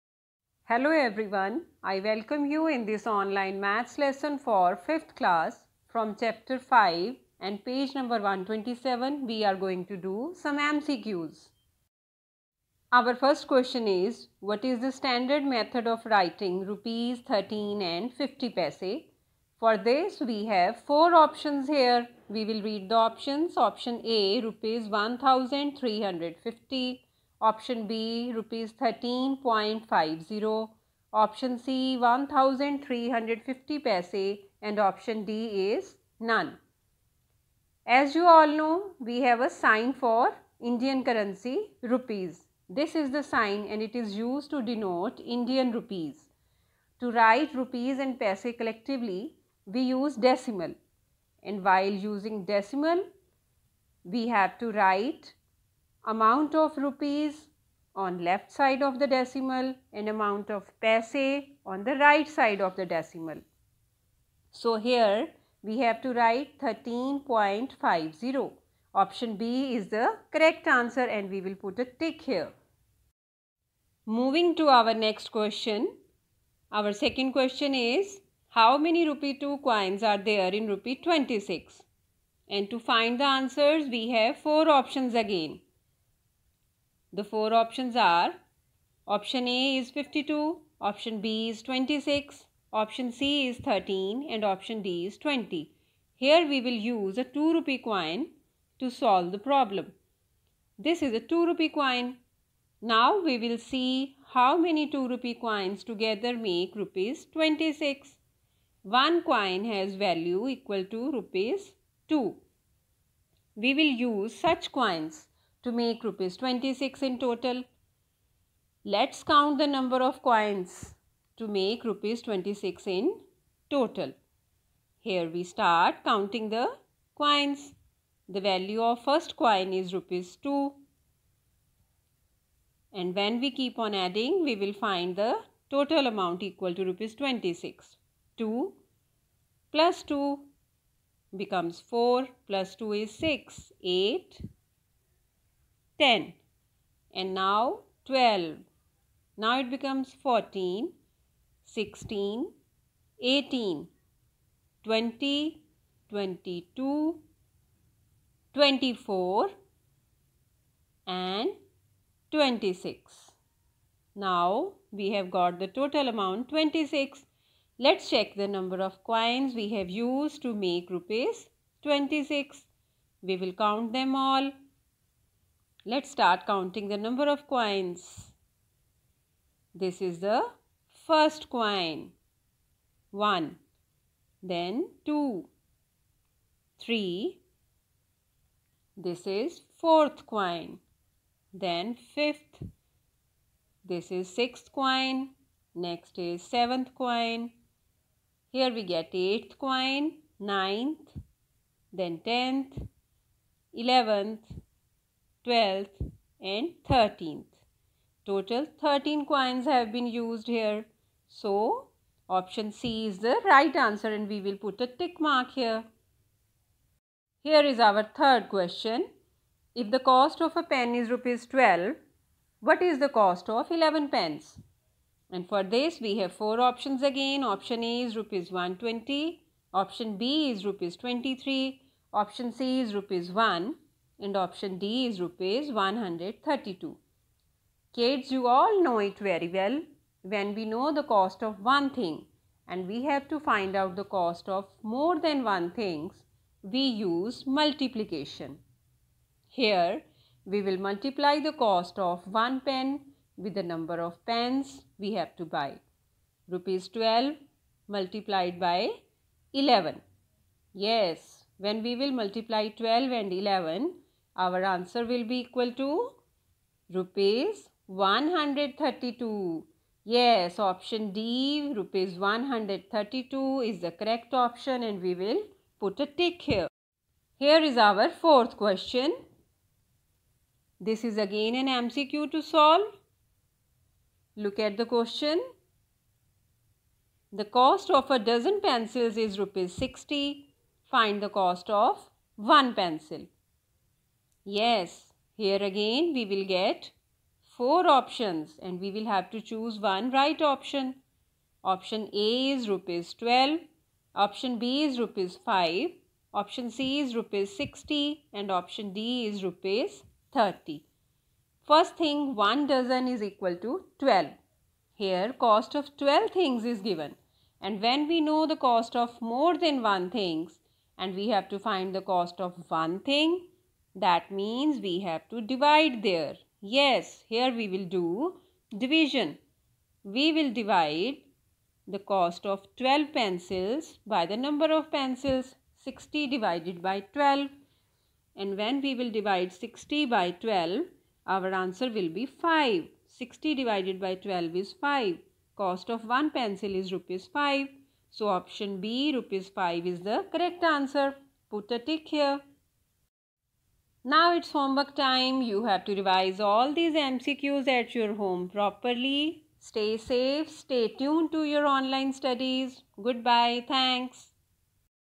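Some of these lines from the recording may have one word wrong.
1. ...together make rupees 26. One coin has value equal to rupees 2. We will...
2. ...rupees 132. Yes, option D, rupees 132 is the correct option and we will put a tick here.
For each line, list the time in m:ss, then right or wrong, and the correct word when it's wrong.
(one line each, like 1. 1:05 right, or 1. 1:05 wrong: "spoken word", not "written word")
1. 1:45 right
2. 4:26 right.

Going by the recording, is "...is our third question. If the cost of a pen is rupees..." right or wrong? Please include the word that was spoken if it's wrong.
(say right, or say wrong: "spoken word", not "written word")
right.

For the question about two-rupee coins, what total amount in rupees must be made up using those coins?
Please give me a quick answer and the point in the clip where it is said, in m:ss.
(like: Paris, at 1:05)
Rupees 26, at 1:20.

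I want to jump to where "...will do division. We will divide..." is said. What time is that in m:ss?
5:27.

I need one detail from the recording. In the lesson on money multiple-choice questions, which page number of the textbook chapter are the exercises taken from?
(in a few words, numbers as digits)
127.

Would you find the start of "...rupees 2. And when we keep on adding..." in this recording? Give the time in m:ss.
2:09.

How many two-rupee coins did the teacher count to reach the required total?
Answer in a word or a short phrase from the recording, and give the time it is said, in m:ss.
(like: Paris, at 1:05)
13, at 3:28.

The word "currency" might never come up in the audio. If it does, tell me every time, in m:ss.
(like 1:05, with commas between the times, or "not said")
0:41.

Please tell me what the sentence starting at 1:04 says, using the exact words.
So here we have to write 13.50.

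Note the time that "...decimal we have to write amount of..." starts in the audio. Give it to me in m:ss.
0:52.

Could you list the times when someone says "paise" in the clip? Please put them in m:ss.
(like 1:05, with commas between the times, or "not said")
0:18, 0:33, 0:48, 1:00.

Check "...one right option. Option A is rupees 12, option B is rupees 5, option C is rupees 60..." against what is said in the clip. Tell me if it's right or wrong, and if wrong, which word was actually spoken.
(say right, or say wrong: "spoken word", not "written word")
right.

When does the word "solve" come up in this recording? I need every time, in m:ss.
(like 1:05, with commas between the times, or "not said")
1:38, 4:42.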